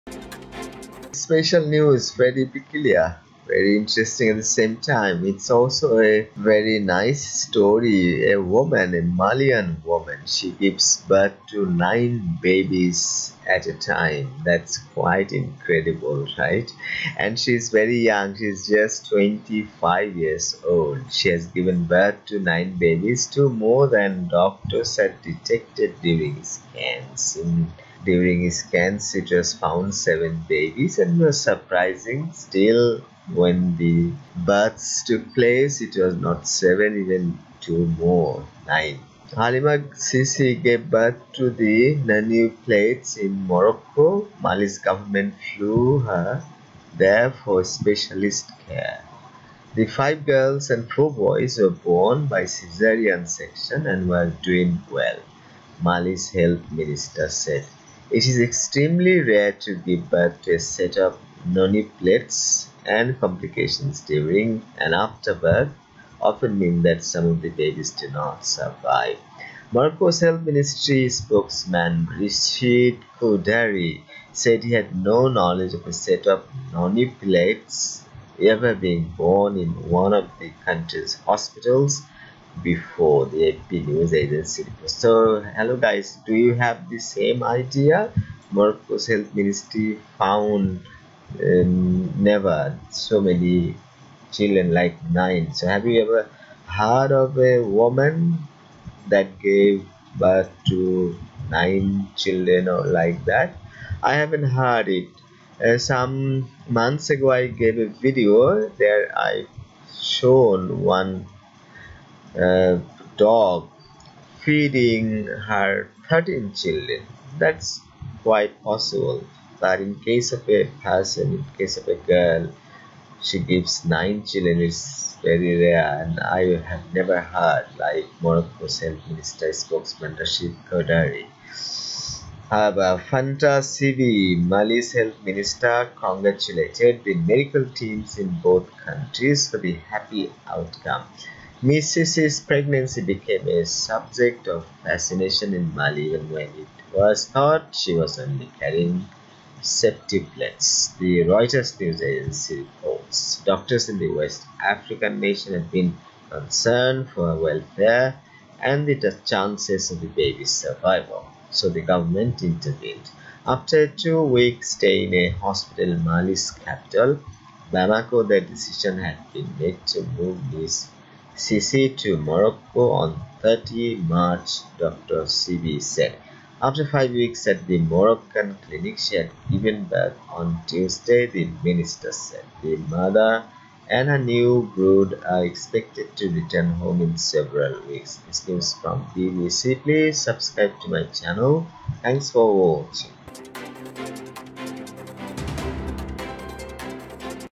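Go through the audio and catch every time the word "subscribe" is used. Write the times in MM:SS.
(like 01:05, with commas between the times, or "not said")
03:10.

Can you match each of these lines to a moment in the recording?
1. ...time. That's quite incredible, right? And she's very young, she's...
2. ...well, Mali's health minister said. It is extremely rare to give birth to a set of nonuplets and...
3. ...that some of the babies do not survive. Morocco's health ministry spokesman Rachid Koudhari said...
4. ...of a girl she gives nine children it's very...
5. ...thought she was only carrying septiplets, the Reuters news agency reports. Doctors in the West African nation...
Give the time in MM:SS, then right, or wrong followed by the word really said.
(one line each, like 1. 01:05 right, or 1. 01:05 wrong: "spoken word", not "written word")
1. 00:13 right
2. 00:54 right
3. 01:06 right
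4. 02:01 right
5. 02:27 right.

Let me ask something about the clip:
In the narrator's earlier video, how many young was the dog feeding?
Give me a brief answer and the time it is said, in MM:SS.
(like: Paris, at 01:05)
13, at 01:56.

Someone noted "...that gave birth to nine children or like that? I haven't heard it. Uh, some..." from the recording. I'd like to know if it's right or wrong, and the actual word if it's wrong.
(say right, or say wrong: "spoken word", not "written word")
right.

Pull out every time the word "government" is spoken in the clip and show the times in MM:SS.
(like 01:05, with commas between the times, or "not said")
00:44, 02:41.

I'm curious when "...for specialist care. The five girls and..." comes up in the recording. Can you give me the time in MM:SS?
00:47.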